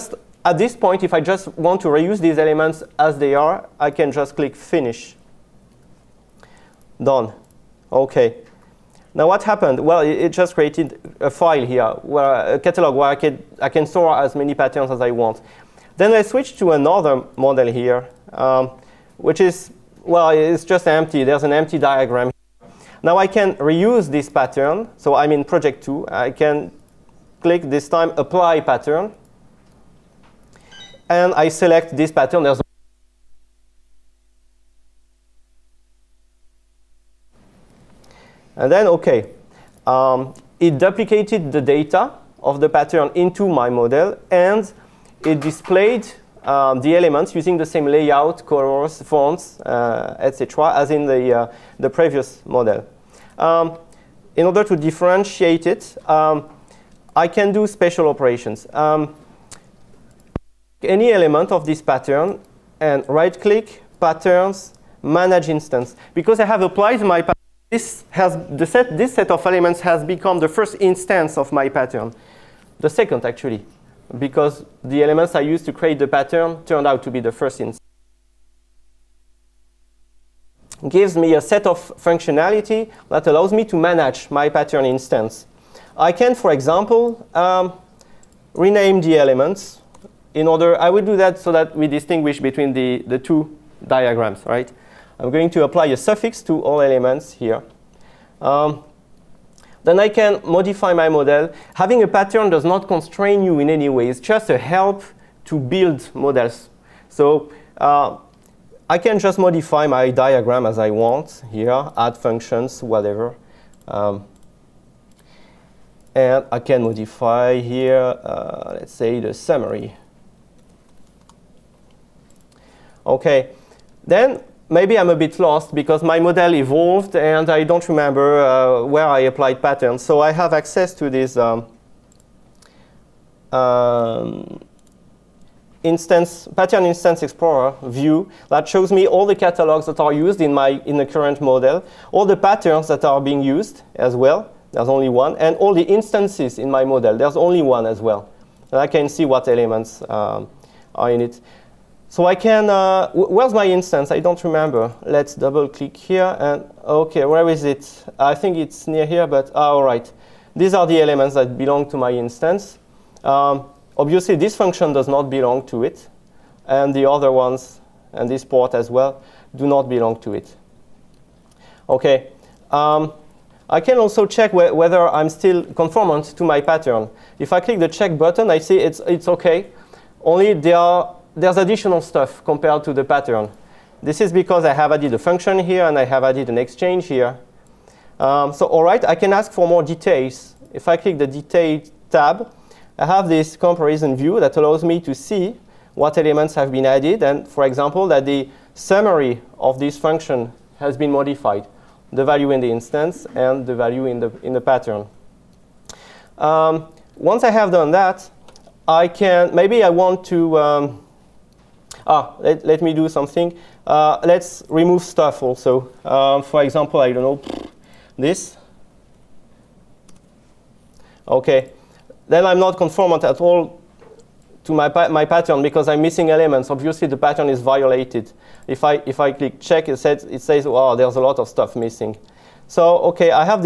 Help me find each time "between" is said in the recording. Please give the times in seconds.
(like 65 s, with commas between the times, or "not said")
92 s.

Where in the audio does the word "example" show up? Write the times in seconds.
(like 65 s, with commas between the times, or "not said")
86 s, 197 s, 216 s.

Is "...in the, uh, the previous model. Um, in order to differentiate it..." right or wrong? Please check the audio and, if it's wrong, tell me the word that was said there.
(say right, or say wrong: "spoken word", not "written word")
right.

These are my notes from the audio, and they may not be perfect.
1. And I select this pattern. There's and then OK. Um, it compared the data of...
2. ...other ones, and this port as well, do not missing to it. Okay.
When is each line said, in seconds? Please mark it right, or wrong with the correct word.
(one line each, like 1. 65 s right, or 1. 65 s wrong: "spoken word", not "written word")
1. 31 s wrong: "duplicated", not "compared"
2. 167 s wrong: "belong", not "missing".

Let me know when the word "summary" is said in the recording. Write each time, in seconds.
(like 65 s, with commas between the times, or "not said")
119 s, 198 s.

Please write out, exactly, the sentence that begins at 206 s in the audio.
Um, once I have done that, I can, maybe I want to um, ah, let, let me do something.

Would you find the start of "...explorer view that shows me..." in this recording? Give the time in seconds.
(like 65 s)
137 s.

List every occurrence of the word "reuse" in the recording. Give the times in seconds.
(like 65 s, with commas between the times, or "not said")
1 s, 23 s.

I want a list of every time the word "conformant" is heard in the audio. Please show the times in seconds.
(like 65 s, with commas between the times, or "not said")
175 s, 222 s.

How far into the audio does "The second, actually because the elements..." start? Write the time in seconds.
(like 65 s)
72 s.